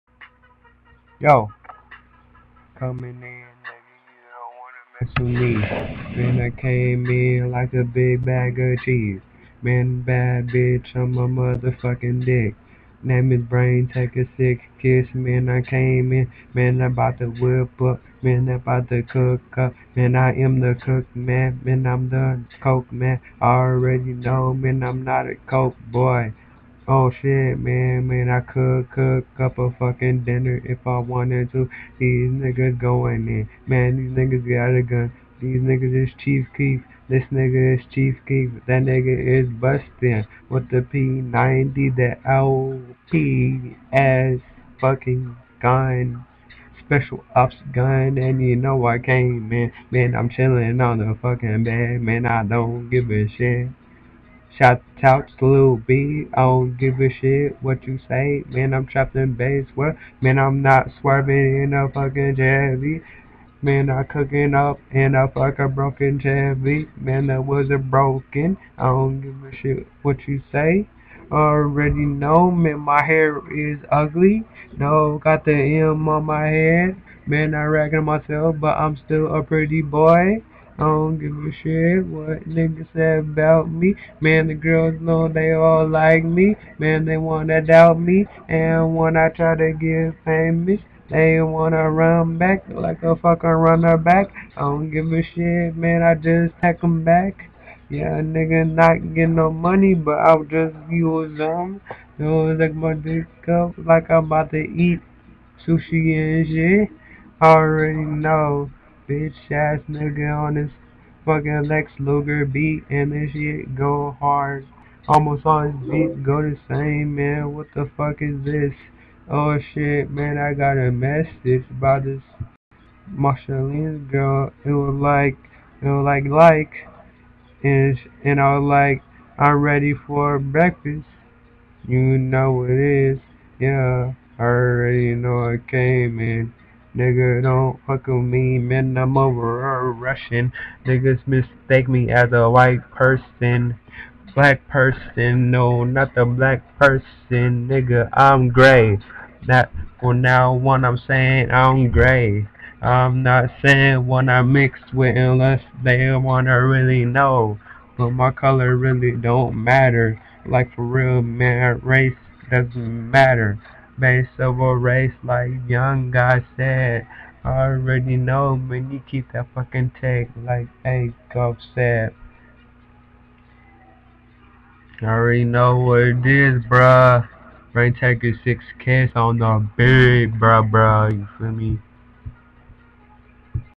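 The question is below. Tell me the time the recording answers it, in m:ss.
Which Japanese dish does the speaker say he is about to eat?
1:45.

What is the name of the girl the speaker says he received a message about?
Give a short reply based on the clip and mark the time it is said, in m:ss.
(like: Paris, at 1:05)
Marceline, at 2:03.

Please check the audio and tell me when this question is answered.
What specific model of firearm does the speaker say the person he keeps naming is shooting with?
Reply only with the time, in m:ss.
0:40.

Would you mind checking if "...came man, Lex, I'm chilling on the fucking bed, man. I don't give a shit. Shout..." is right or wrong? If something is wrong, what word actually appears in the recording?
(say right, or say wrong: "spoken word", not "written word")
wrong: "Man", not "Lex".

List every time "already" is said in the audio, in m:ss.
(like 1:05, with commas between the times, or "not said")
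0:23, 1:11, 1:47, 2:14, 2:47, 2:55.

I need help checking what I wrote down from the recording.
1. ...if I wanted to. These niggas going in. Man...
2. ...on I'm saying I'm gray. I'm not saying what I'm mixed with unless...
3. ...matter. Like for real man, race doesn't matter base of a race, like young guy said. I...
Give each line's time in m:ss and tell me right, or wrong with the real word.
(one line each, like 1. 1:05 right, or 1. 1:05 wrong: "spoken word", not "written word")
1. 0:30 right
2. 2:30 right
3. 2:39 right.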